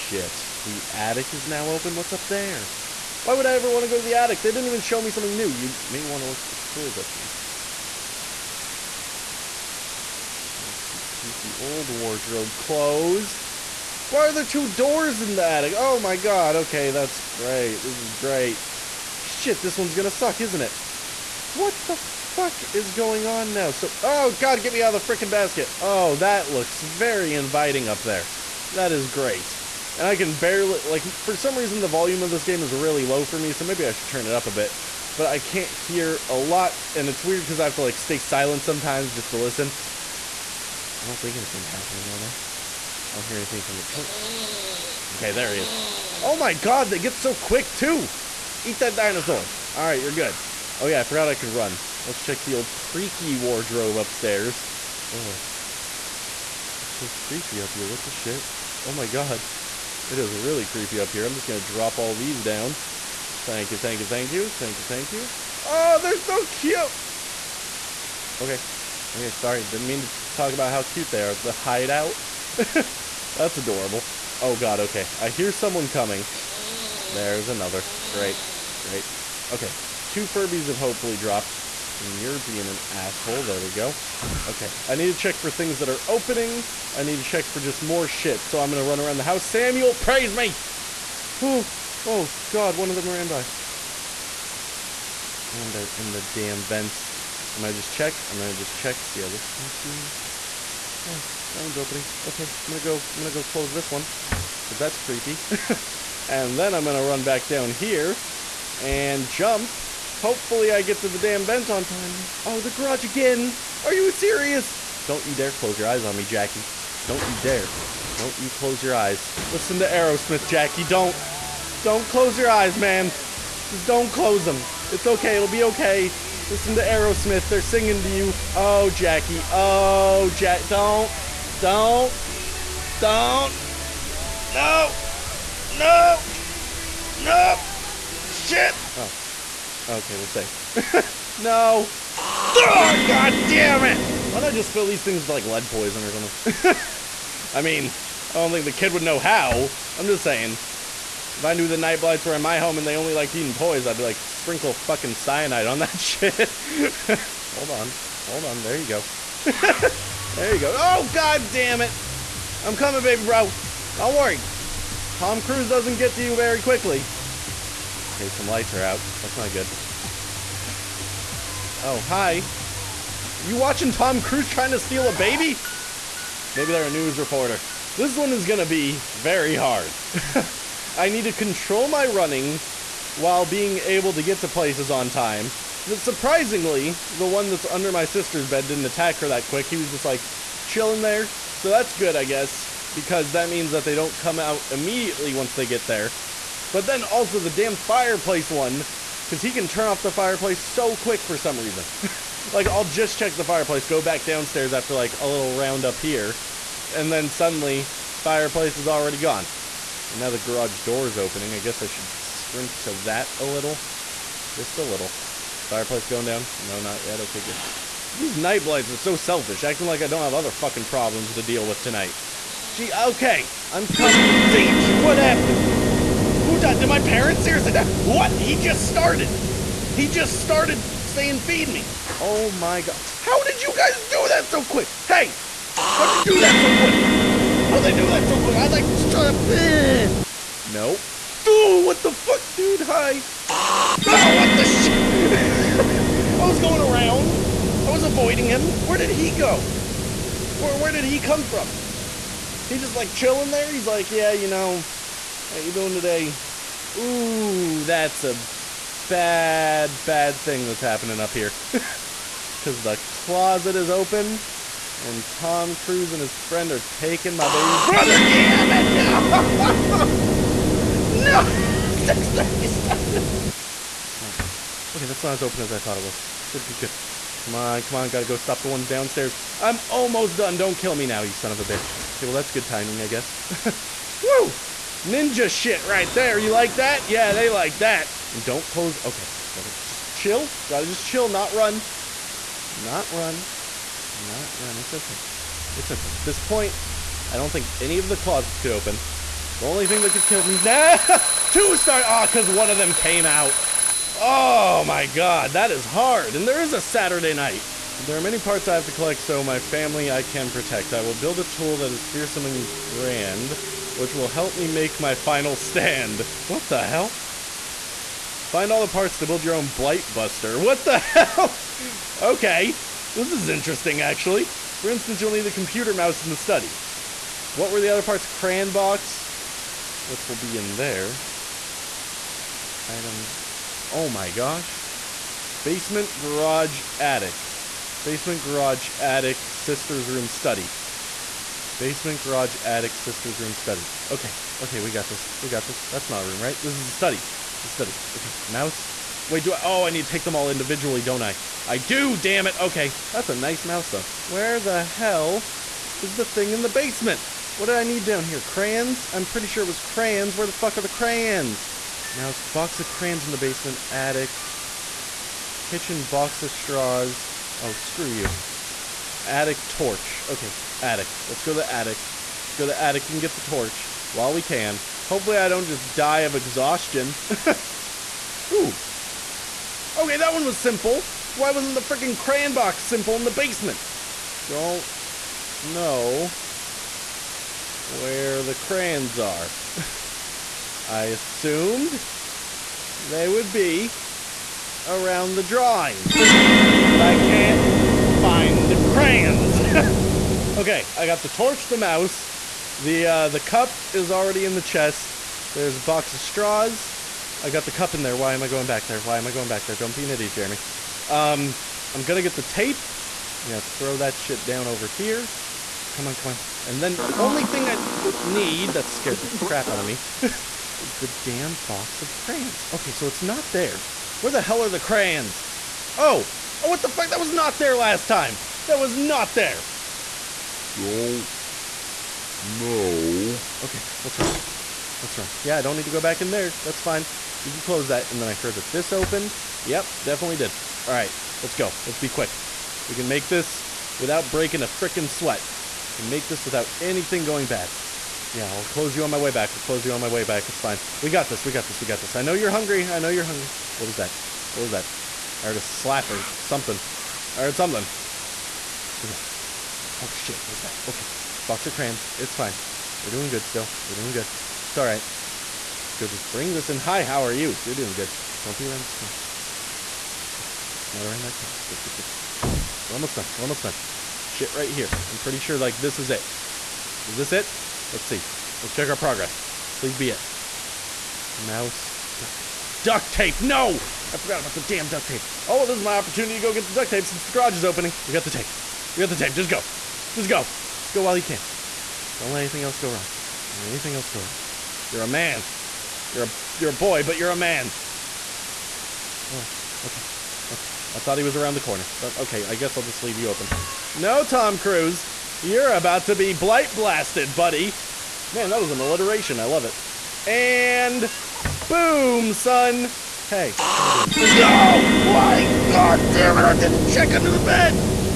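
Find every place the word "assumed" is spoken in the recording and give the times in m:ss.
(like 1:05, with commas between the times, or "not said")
6:31.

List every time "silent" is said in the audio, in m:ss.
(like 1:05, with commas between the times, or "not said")
0:38.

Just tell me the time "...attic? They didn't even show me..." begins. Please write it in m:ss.
0:04.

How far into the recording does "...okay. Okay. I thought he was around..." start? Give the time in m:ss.
8:19.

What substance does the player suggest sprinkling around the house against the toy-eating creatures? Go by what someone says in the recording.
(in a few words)
cyanide.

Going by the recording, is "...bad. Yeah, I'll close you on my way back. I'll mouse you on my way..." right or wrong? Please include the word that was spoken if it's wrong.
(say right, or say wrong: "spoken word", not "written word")
wrong: "close", not "mouse".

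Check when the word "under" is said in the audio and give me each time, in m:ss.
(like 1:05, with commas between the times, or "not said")
3:07, 8:37.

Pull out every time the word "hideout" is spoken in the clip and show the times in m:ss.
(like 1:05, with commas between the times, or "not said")
1:11.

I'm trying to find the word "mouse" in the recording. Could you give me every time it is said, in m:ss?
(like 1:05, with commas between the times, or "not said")
5:25, 5:48, 5:53, 6:02, 6:41, 8:01.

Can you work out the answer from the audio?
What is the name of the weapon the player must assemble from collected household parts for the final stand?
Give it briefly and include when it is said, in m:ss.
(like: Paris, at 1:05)
Blight Buster, at 5:19.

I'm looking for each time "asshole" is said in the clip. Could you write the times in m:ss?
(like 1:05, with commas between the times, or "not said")
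1:22.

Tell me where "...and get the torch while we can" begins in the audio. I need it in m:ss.
6:13.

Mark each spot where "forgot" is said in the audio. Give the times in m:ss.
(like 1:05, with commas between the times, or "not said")
0:51, 8:04.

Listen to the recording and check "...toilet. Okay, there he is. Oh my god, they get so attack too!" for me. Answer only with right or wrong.
wrong.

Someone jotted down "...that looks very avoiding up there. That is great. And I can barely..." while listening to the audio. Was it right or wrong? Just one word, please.
wrong.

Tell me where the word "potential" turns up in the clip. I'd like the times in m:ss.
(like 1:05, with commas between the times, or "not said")
not said.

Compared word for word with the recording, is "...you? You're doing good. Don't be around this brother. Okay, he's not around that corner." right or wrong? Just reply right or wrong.
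wrong.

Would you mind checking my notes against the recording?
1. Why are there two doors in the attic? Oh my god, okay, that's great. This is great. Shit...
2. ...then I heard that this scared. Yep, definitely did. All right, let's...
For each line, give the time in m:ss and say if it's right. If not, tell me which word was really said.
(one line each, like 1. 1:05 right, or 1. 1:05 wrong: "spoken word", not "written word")
1. 0:14 right
2. 7:18 wrong: "opened", not "scared".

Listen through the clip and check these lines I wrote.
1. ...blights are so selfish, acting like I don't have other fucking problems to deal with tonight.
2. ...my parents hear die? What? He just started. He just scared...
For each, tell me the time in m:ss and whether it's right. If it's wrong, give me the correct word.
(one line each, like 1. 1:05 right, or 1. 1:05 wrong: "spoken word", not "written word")
1. 3:38 right
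2. 3:46 wrong: "started", not "scared".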